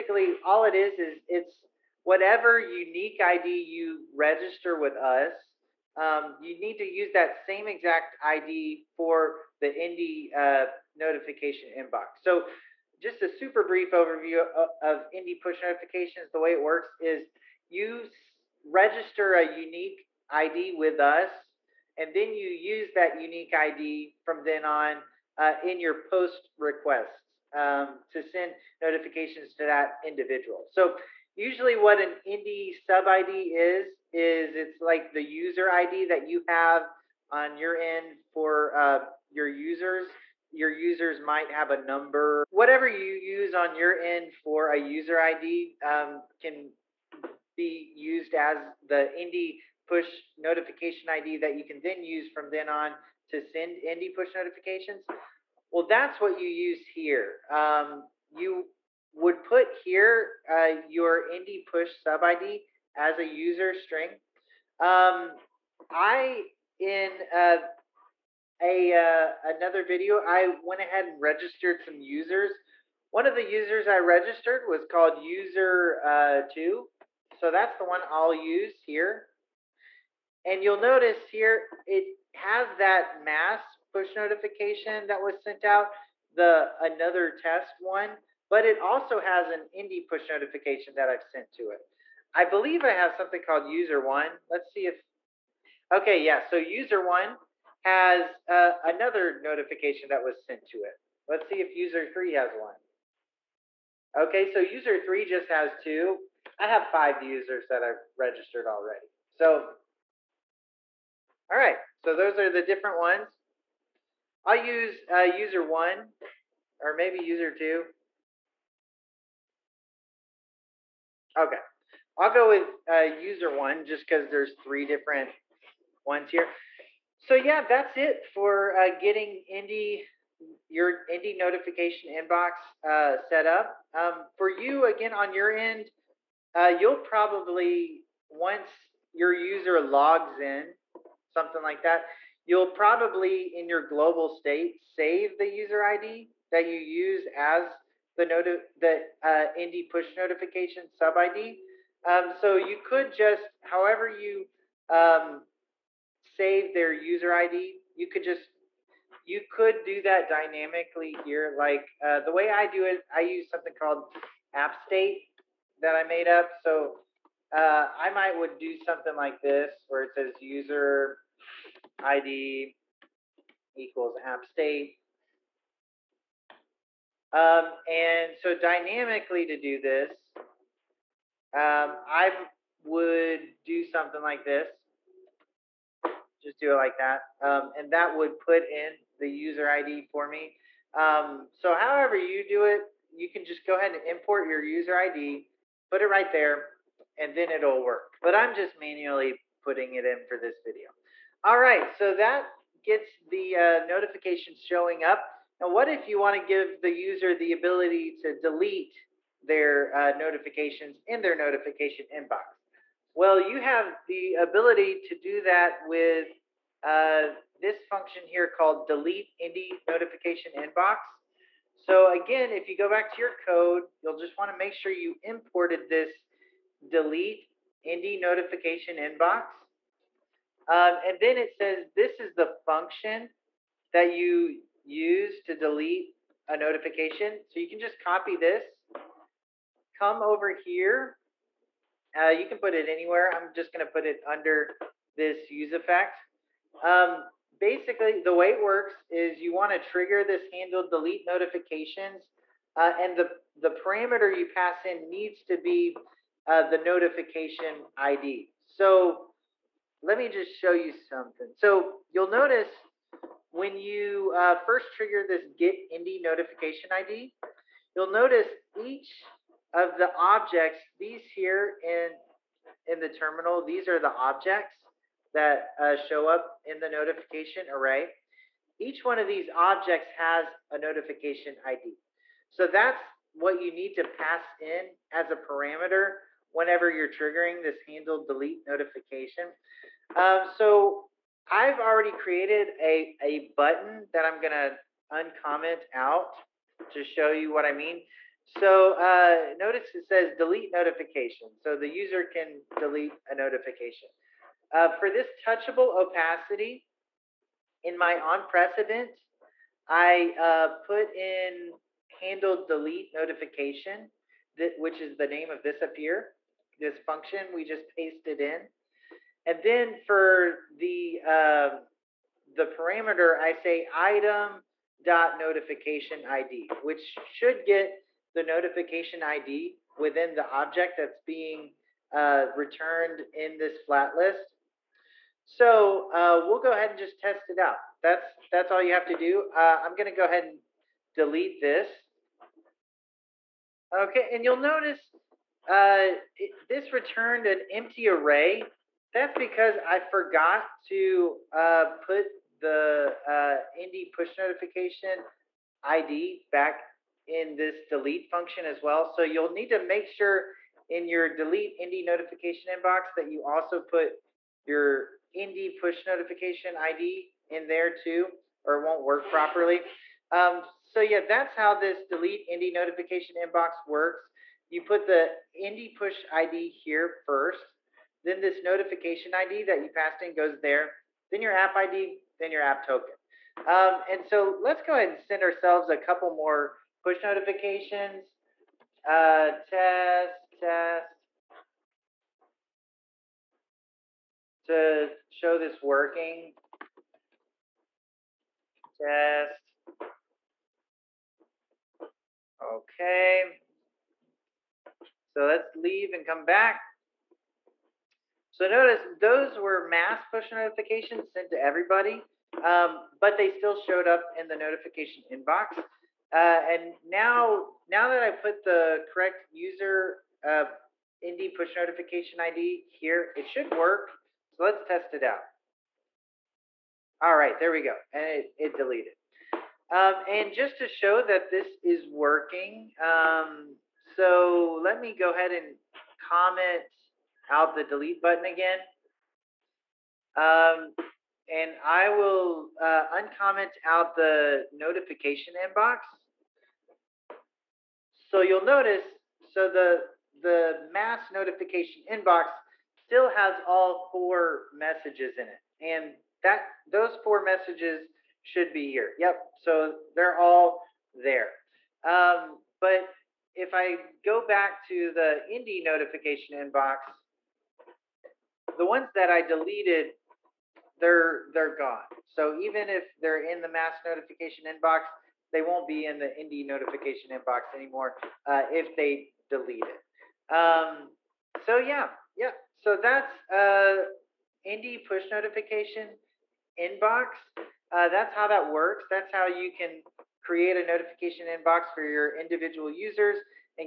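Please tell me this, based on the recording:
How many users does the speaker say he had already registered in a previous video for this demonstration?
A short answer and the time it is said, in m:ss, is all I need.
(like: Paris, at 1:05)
5, at 1:46.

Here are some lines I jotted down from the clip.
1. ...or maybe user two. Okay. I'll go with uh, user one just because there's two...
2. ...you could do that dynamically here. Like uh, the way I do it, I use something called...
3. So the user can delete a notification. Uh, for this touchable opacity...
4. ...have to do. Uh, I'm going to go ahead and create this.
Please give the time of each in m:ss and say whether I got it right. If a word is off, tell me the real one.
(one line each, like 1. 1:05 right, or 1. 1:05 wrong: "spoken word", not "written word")
1. 1:56 wrong: "three", not "two"
2. 2:39 right
3. 5:01 right
4. 5:38 wrong: "delete", not "create".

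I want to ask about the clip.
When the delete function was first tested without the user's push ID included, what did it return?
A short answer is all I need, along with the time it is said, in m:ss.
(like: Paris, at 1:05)
an empty array, at 5:47.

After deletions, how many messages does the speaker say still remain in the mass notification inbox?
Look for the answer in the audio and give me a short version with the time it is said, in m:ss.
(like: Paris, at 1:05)
4, at 7:33.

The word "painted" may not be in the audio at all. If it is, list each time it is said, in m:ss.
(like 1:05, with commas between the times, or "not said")
not said.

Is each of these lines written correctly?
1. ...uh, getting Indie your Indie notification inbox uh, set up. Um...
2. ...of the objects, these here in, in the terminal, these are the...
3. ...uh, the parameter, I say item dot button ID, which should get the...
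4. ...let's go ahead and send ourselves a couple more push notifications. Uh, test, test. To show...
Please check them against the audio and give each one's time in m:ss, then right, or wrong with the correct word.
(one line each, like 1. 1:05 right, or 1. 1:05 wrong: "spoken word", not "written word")
1. 2:08 right
2. 4:29 right
3. 5:21 wrong: "notification", not "button"
4. 6:24 right.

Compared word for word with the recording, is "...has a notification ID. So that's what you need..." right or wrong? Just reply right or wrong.
right.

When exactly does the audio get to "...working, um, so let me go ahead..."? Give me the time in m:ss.
7:12.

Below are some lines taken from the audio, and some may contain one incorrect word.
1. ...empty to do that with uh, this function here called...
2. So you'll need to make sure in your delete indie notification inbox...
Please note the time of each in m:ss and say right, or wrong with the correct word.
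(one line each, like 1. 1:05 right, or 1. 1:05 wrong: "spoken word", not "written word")
1. 3:34 wrong: "ability", not "empty"
2. 5:59 right.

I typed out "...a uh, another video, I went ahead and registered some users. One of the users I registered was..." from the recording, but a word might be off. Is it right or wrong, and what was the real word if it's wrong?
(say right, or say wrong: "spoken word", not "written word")
right.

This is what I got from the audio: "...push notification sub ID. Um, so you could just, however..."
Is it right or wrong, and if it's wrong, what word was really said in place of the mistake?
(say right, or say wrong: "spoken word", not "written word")
right.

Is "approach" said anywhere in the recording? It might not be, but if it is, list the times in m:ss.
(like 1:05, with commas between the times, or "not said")
not said.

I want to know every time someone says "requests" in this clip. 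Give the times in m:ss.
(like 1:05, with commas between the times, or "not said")
0:26.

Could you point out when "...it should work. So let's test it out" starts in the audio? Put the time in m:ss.
7:03.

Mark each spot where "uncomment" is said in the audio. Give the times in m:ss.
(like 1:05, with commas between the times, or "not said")
4:55, 7:23.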